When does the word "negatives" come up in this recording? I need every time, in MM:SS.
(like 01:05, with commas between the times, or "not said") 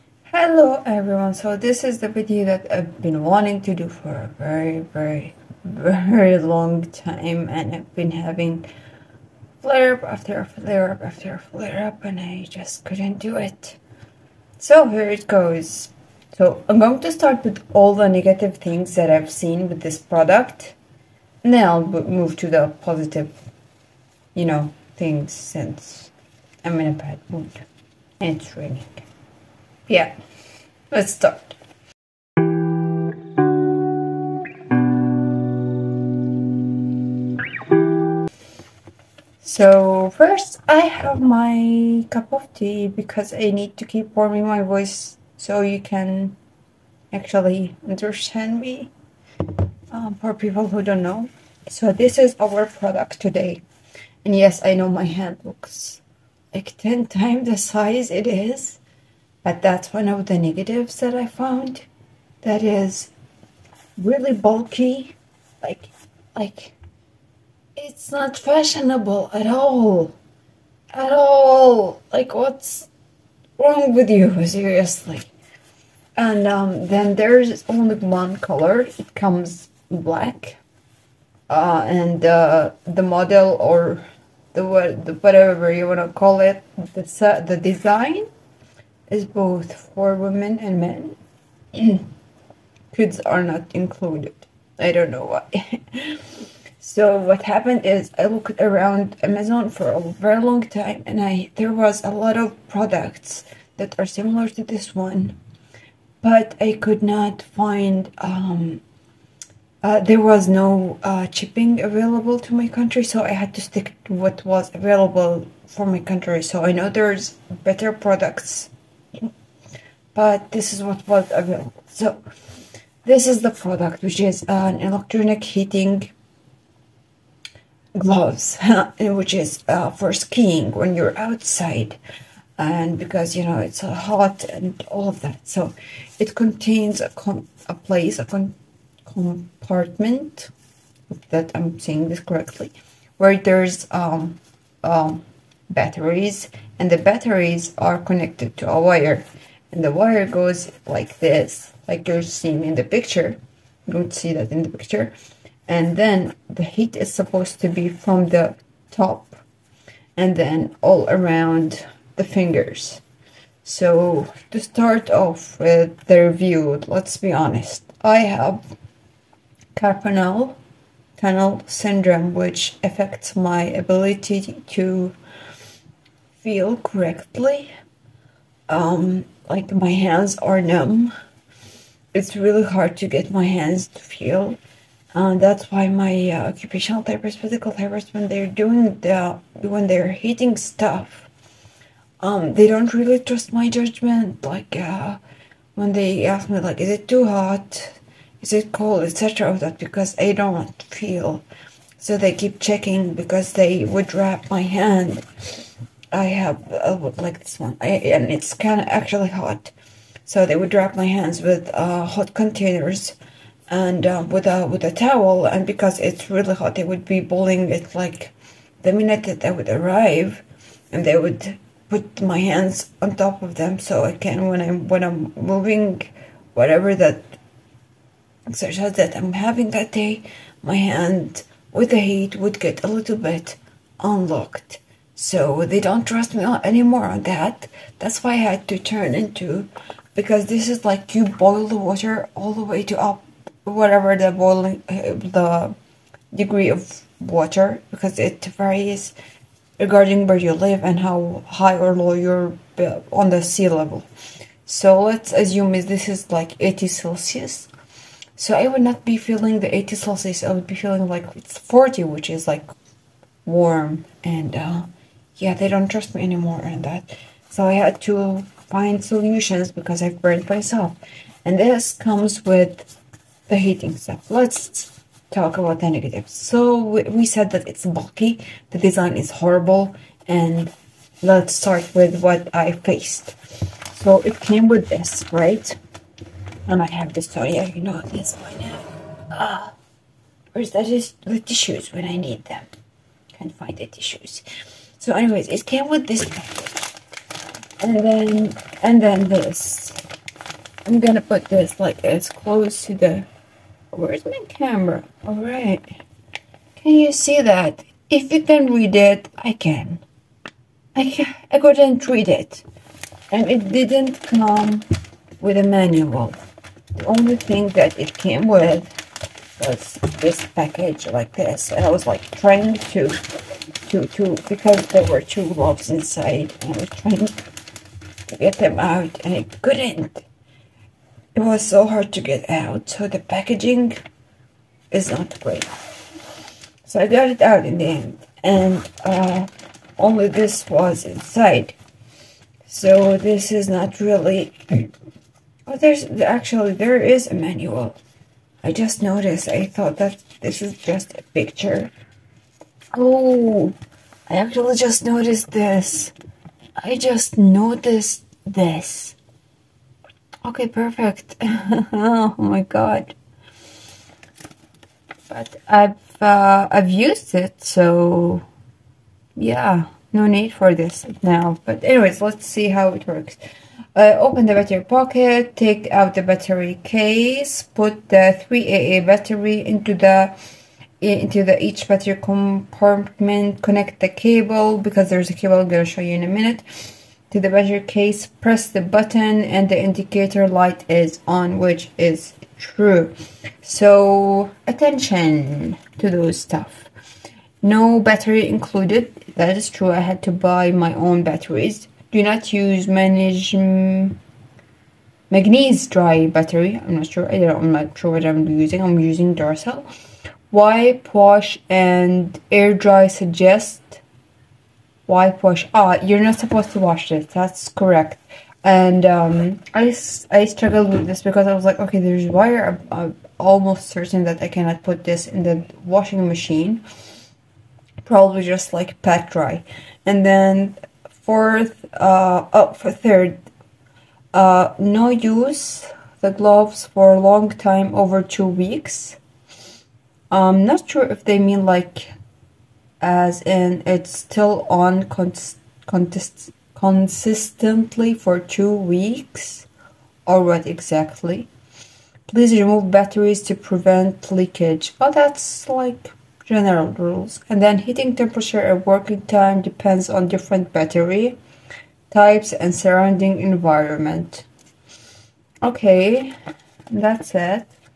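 00:18, 01:00, 04:35.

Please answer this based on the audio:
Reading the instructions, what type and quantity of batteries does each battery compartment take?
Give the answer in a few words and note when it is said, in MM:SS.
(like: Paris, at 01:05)
3 AA, at 06:18.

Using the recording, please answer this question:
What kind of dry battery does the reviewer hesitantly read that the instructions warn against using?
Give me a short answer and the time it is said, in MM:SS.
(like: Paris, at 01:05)
Magnesium, at 06:45.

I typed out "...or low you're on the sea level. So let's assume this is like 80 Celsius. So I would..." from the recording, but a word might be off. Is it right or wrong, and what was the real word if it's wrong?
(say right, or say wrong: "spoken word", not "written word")
right.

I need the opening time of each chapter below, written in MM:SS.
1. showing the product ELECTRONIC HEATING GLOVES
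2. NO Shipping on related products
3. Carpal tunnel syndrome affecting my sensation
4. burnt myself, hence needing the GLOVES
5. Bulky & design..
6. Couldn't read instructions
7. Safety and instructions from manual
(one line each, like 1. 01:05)
1. 00:49
2. 01:49
3. 02:49
4. 03:19
5. 04:29
6. 04:59
7. 06:34.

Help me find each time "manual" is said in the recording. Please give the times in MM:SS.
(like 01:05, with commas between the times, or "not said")
05:15, 05:47.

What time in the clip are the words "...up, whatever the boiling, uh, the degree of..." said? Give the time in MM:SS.
04:02.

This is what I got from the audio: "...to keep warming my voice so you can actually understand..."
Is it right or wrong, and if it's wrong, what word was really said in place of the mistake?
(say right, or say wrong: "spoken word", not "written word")
right.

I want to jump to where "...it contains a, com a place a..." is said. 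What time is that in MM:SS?
02:16.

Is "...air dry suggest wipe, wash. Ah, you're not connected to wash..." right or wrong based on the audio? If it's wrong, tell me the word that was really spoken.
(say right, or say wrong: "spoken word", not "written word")
wrong: "supposed", not "connected".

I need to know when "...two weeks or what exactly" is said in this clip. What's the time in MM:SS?
07:28.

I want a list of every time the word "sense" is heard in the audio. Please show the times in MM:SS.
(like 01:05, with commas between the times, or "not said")
not said.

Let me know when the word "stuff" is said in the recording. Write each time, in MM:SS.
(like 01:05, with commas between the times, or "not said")
03:10, 04:33, 06:36.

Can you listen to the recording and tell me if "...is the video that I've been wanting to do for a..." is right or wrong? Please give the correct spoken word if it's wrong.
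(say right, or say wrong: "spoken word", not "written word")
right.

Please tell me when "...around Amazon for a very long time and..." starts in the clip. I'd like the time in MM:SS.
01:38.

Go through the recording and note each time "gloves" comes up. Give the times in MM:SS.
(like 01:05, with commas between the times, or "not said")
02:07, 07:16.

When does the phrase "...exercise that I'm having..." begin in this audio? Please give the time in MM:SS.
03:48.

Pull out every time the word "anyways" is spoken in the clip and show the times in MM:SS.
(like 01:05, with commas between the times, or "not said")
04:55, 06:11.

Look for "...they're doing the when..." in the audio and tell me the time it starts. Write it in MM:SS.
03:08.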